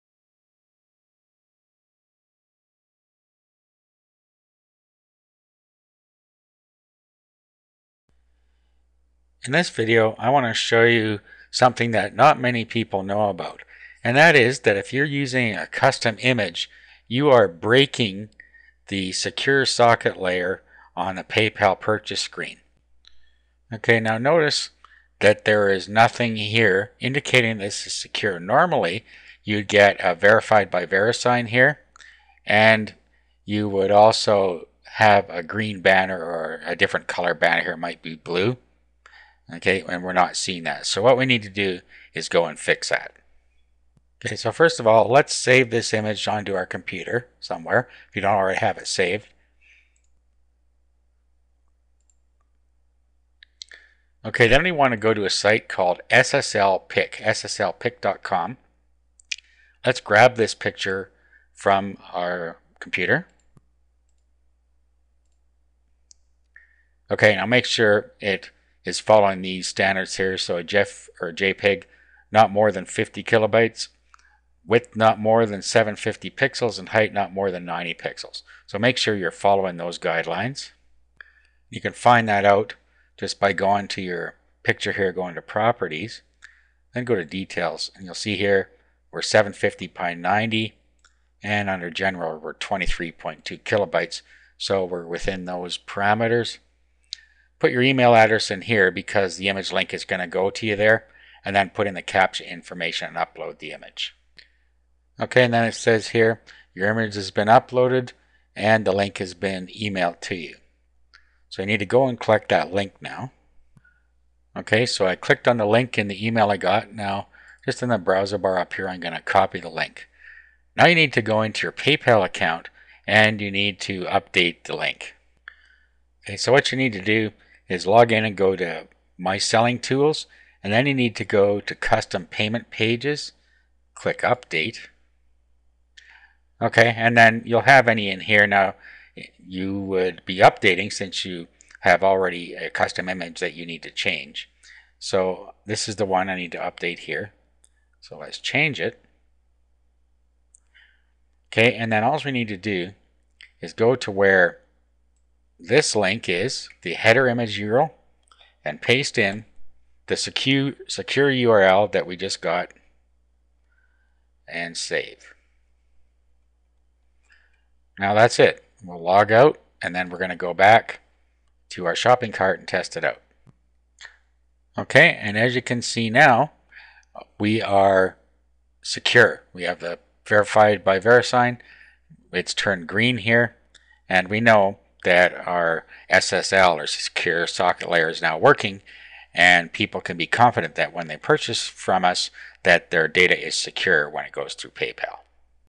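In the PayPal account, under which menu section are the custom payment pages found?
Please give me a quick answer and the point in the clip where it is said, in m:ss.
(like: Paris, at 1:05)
My Selling Tools, at 2:09.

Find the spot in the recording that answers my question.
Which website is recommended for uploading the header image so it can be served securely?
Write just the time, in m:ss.
0:57.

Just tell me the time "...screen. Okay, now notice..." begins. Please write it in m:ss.
0:22.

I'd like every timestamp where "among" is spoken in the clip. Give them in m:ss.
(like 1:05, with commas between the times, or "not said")
not said.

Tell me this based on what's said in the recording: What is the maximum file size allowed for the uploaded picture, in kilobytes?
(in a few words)
50 kilobytes.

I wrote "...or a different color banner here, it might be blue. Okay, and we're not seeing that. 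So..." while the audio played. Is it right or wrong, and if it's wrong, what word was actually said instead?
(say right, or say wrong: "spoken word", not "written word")
right.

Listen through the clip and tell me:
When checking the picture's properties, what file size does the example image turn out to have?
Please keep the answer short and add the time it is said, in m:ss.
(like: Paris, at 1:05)
23.2 kilobytes, at 1:32.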